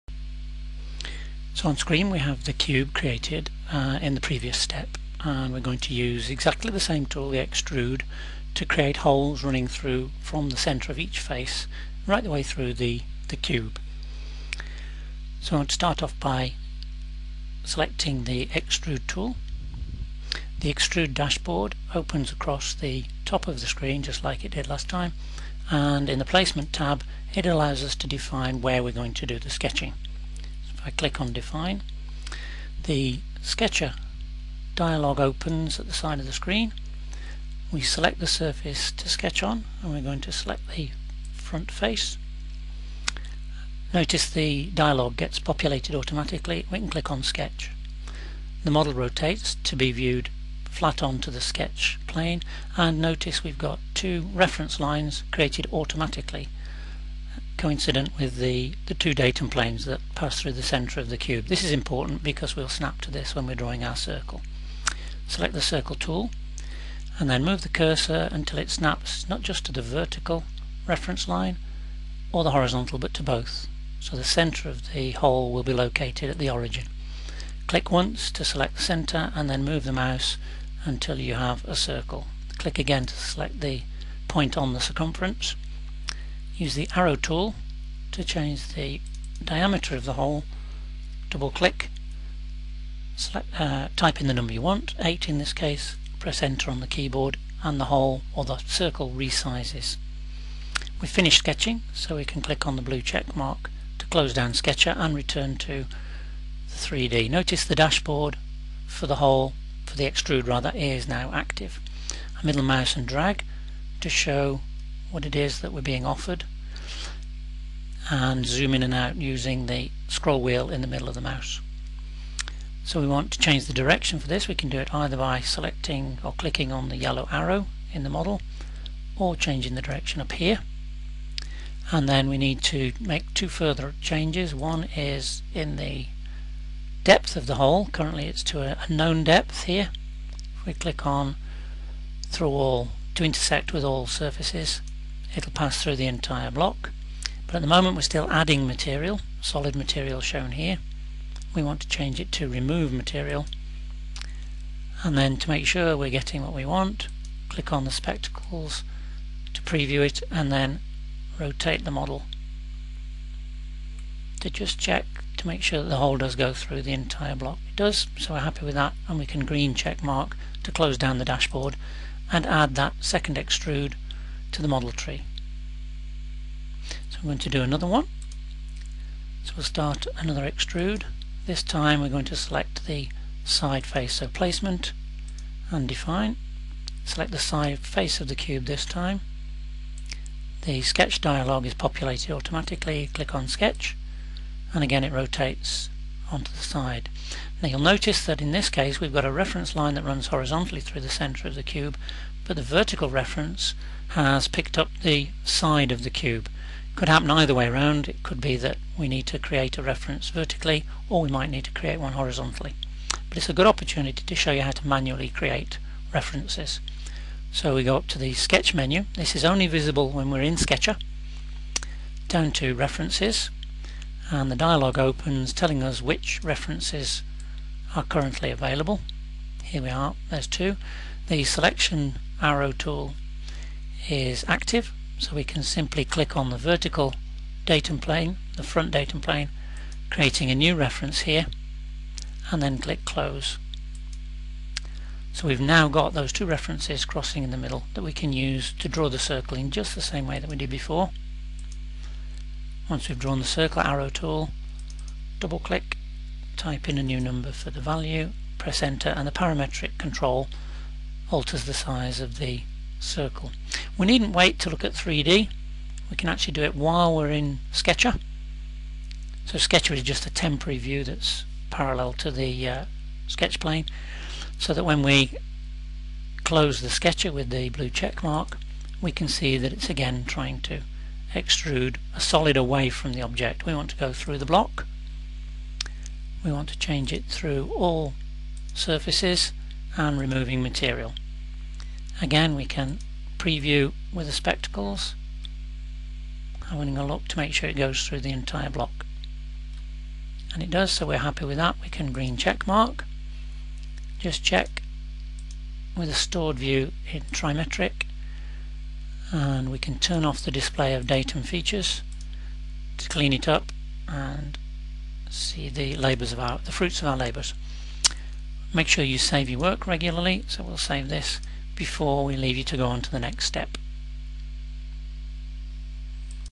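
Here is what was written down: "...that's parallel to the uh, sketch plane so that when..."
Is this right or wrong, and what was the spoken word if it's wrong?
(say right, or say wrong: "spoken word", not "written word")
right.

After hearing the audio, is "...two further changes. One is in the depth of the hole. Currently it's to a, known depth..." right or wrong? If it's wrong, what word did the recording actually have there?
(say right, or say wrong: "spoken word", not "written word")
right.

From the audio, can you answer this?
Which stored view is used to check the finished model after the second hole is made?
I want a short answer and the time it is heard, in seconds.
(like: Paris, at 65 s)
Trimetric, at 307 s.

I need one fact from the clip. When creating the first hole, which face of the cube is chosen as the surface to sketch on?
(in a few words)
Front face.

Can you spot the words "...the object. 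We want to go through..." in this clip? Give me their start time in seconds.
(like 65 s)
283 s.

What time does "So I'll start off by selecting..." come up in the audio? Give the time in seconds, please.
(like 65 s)
15 s.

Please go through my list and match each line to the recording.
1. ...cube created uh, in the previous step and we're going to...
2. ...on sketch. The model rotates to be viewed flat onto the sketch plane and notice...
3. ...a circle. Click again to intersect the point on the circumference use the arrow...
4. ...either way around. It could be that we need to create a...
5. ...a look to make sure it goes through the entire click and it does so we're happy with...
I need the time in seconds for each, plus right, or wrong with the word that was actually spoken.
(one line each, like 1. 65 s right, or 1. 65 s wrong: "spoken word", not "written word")
1. 2 s right
2. 47 s right
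3. 81 s wrong: "select", not "intersect"
4. 207 s right
5. 296 s wrong: "block", not "click".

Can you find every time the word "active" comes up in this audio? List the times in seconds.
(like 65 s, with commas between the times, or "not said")
111 s, 234 s.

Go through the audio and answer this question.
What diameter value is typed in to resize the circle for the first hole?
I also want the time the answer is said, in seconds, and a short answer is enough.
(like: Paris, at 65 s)
8, at 94 s.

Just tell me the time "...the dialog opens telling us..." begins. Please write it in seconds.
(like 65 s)
224 s.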